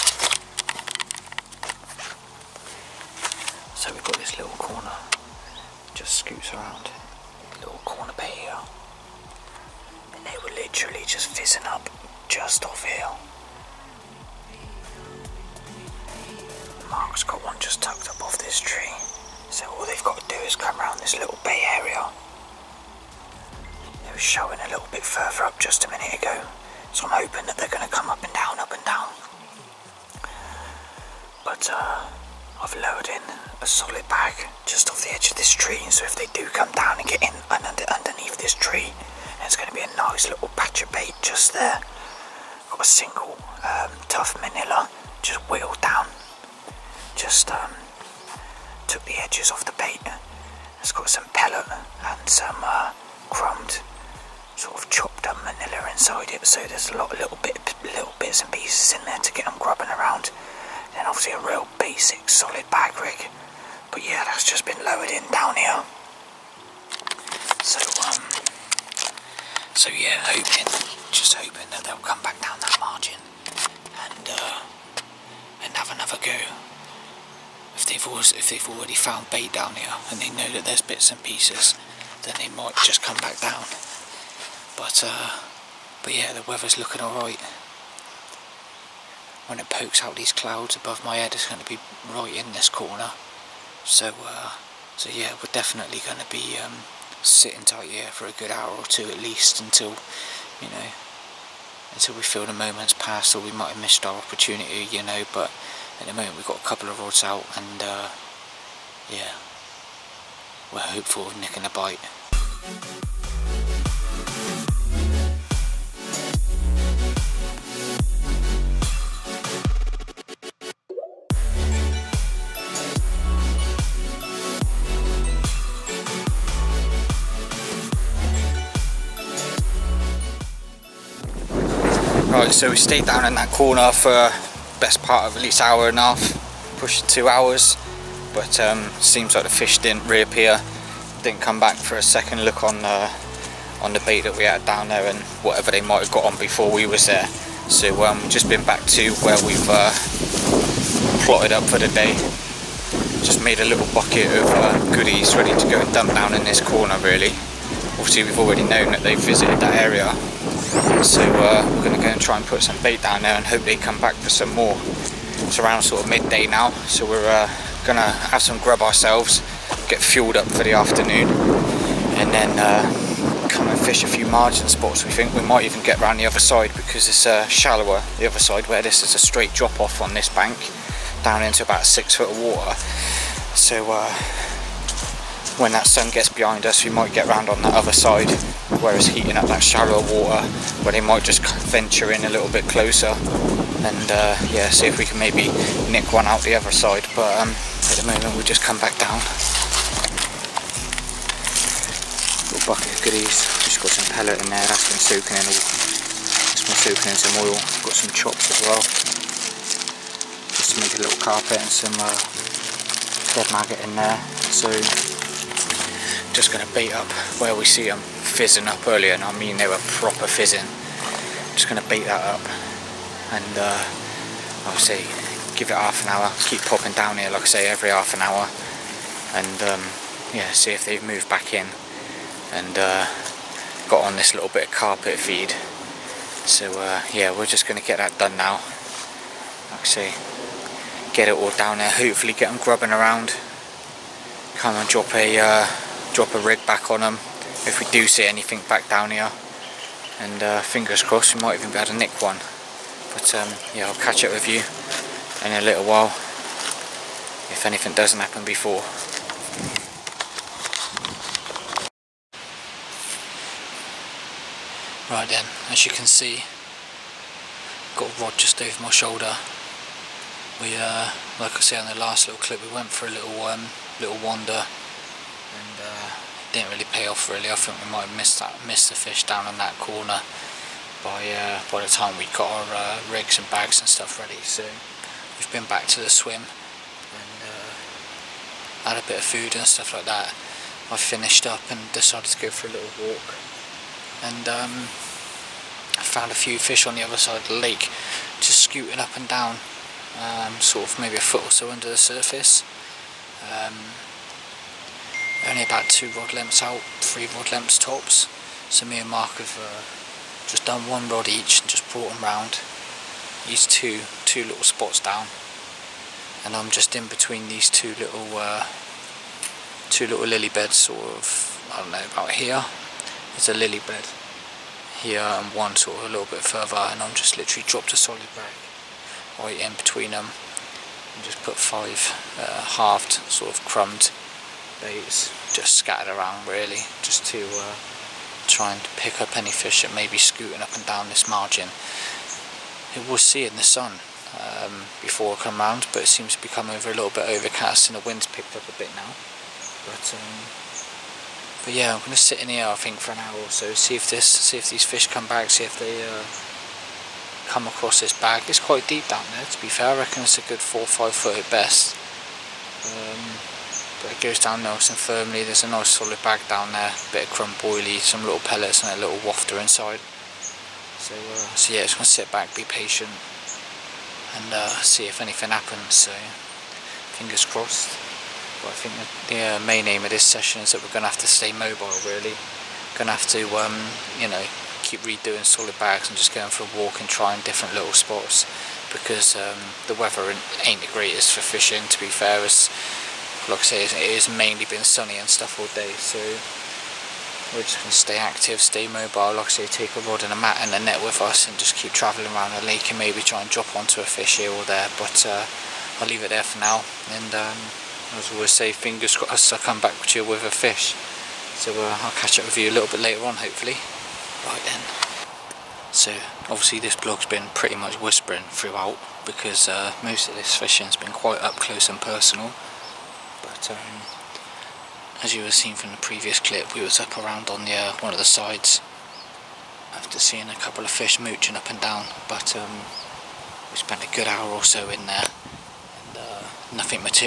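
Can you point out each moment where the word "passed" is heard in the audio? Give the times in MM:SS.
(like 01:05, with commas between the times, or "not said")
01:42.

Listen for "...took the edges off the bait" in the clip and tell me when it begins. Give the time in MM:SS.
00:48.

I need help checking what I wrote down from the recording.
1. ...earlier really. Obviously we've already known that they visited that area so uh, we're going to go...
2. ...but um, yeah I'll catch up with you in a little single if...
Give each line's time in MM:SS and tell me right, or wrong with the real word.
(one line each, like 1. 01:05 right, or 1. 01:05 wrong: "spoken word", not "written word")
1. 02:36 wrong: "corner", not "earlier"
2. 04:13 wrong: "while", not "single".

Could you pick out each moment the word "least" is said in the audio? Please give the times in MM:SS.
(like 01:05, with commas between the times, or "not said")
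01:39, 02:15.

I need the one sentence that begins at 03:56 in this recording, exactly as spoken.
So uh, yeah, we're just going to get that done now.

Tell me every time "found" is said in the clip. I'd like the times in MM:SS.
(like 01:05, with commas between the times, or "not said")
01:18, 04:56.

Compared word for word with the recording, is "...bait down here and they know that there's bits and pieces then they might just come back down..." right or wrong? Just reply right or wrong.
right.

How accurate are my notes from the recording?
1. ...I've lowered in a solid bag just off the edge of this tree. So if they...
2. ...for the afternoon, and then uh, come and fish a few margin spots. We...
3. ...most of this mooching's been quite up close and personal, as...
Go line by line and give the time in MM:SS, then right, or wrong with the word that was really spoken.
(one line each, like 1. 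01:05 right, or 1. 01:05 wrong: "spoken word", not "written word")
1. 00:32 right
2. 02:50 right
3. 07:00 wrong: "fishing", not "mooching".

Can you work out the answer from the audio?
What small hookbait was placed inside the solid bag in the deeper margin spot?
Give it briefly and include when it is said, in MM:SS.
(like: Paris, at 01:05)
wafter, at 06:09.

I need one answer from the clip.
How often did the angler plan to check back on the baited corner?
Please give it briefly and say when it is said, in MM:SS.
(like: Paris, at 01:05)
every half an hour, at 03:47.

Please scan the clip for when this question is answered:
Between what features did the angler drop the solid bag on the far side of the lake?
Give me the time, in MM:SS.
05:23.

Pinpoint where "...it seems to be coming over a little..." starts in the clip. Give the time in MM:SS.
05:46.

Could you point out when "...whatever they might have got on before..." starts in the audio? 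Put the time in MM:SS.
02:25.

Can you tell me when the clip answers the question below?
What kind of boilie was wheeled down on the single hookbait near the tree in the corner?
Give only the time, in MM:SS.
00:44.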